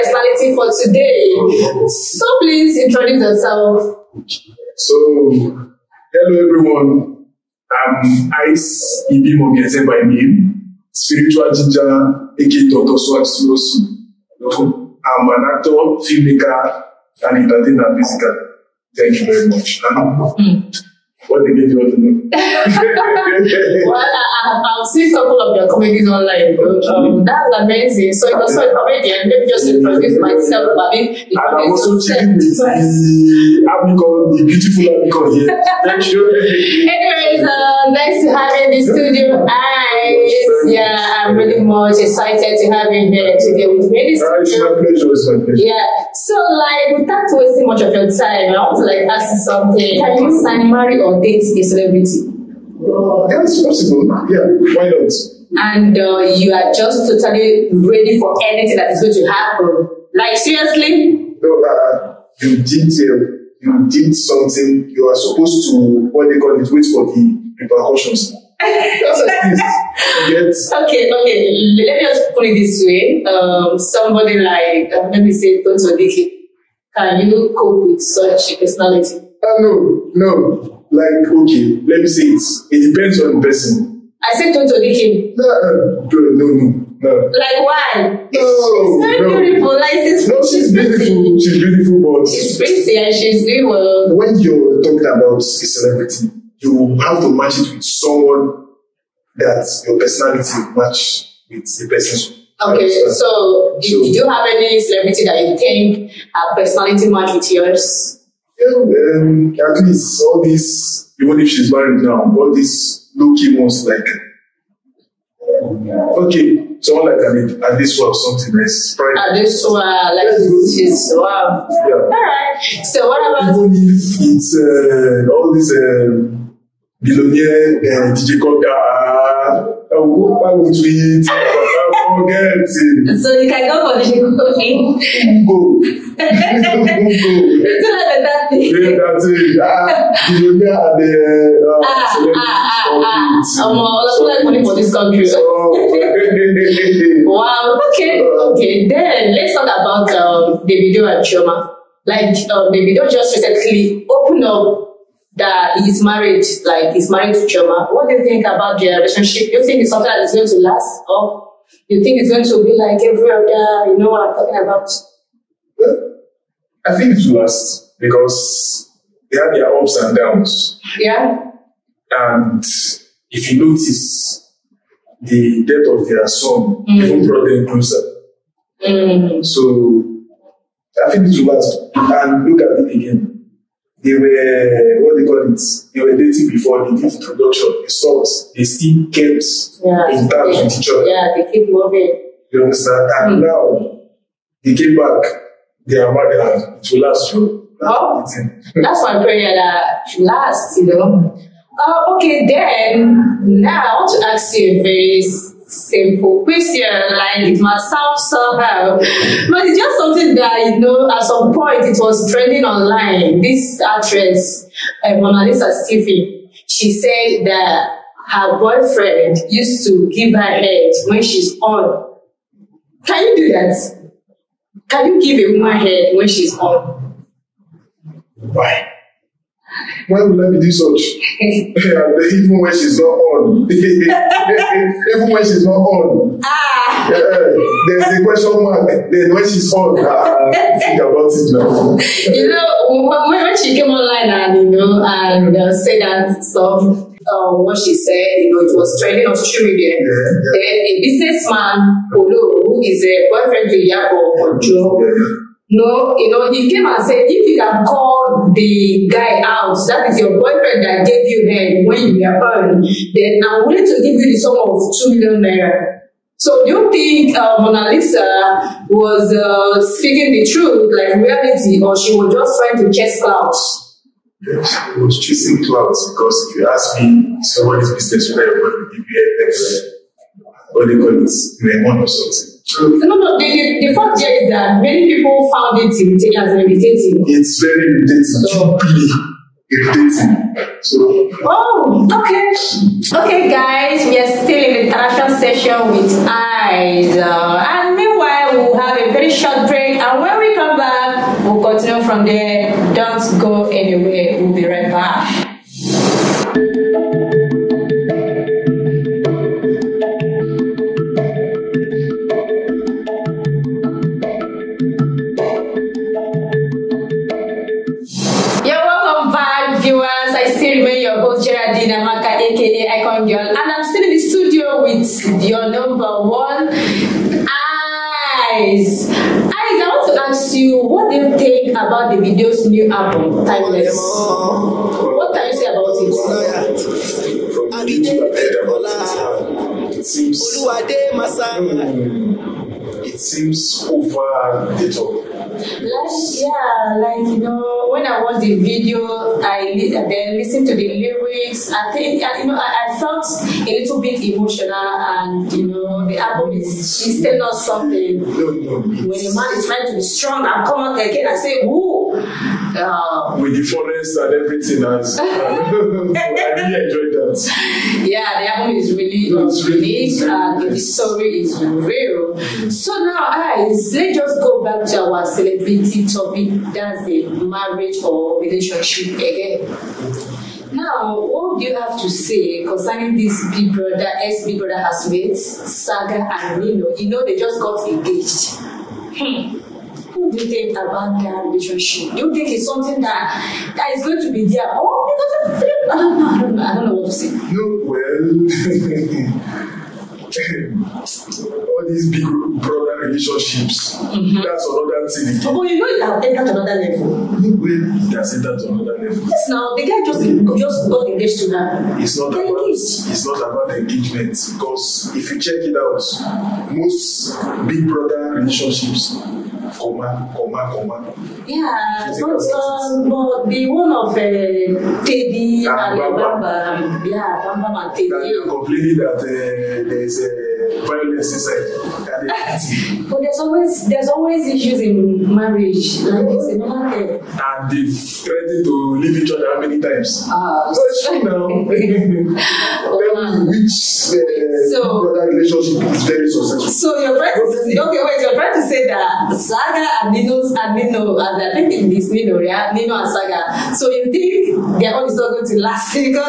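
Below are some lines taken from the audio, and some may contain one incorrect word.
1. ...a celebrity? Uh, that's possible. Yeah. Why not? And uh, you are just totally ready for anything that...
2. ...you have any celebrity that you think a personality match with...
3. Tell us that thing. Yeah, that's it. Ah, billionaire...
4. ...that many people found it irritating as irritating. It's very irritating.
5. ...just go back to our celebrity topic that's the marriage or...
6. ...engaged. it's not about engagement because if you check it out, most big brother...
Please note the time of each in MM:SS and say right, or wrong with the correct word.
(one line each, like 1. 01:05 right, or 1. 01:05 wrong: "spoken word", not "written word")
1. 00:51 right
2. 01:44 right
3. 02:17 right
4. 04:44 right
5. 06:14 right
6. 06:52 right.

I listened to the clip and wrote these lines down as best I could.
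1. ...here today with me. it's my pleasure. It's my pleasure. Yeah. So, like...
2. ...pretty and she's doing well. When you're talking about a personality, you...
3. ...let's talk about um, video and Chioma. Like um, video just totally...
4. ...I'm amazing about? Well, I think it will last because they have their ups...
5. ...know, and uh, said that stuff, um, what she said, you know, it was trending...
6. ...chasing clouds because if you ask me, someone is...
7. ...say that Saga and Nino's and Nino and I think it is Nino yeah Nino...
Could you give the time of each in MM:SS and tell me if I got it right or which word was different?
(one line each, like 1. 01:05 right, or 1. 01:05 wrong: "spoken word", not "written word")
1. 00:43 right
2. 01:32 wrong: "celebrity", not "personality"
3. 02:29 wrong: "recently", not "totally"
4. 02:44 wrong: "talking", not "amazing"
5. 04:04 right
6. 04:35 right
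7. 07:28 right.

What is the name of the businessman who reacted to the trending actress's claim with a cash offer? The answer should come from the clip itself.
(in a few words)
Polo.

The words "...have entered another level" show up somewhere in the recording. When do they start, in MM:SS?
06:46.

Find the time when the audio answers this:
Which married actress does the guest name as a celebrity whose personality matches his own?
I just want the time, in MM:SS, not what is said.
01:59.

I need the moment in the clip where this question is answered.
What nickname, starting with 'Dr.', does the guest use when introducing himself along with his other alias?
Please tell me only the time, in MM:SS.
00:12.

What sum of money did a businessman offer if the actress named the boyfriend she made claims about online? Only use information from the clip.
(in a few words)
2 million naira.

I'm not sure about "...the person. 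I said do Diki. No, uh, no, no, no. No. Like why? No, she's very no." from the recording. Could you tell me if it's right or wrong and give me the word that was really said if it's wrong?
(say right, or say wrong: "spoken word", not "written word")
right.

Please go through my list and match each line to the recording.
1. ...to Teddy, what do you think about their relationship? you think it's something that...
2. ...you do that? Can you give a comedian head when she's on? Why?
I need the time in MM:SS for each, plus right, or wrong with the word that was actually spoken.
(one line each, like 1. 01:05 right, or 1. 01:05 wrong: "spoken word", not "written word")
1. 02:37 wrong: "Chioma", not "Teddy"
2. 03:43 wrong: "woman", not "comedian".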